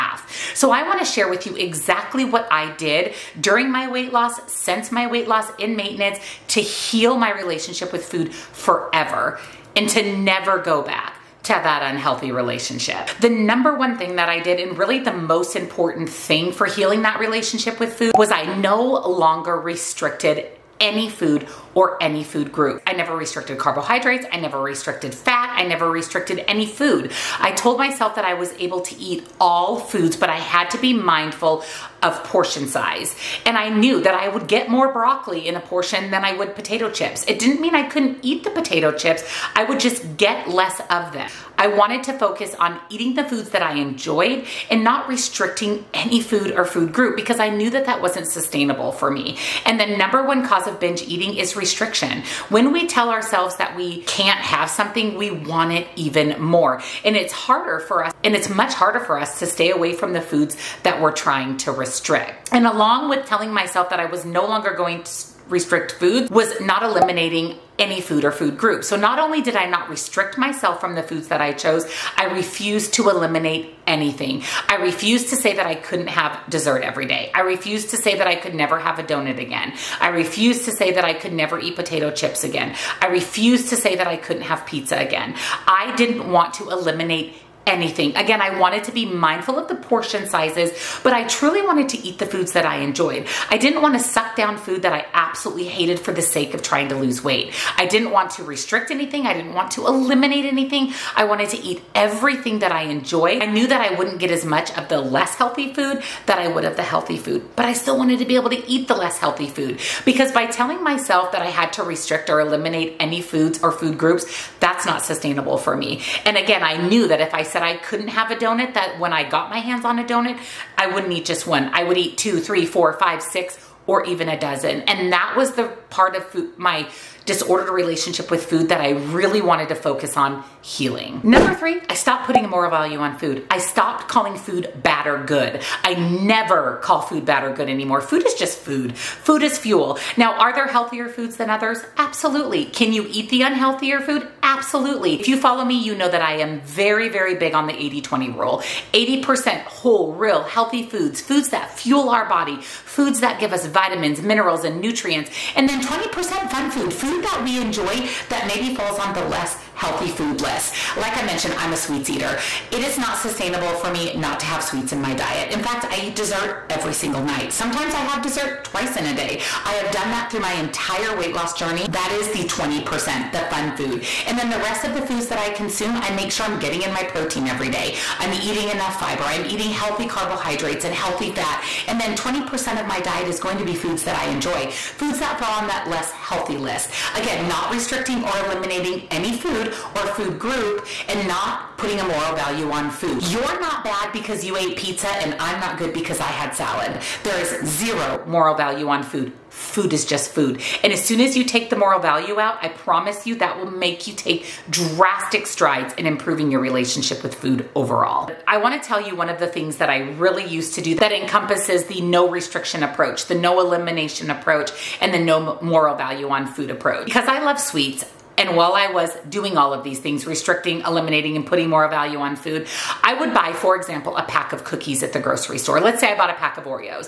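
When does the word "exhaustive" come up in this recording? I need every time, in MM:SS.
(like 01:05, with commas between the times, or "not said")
not said.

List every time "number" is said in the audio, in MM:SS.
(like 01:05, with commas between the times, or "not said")
00:13, 00:49, 02:11.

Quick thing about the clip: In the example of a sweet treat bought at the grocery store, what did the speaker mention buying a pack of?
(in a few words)
cookies.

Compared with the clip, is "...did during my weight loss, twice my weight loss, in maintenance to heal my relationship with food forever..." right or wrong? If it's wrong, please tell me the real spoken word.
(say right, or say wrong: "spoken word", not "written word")
wrong: "since", not "twice".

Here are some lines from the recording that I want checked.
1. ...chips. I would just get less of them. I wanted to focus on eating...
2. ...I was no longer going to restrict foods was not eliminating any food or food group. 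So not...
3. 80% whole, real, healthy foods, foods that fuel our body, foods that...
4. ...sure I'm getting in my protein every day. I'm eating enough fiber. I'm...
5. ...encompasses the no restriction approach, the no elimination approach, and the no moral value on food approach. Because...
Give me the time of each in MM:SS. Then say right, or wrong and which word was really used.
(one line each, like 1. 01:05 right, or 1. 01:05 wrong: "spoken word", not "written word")
1. 00:38 right
2. 01:04 right
3. 02:28 right
4. 02:56 right
5. 03:31 right.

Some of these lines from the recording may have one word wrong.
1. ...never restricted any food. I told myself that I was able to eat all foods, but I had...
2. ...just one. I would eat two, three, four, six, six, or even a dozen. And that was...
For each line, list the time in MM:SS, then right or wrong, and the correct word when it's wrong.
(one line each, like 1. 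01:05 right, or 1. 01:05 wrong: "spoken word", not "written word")
1. 00:25 right
2. 02:01 wrong: "five", not "six".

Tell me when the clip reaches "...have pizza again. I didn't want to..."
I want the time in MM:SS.
01:24.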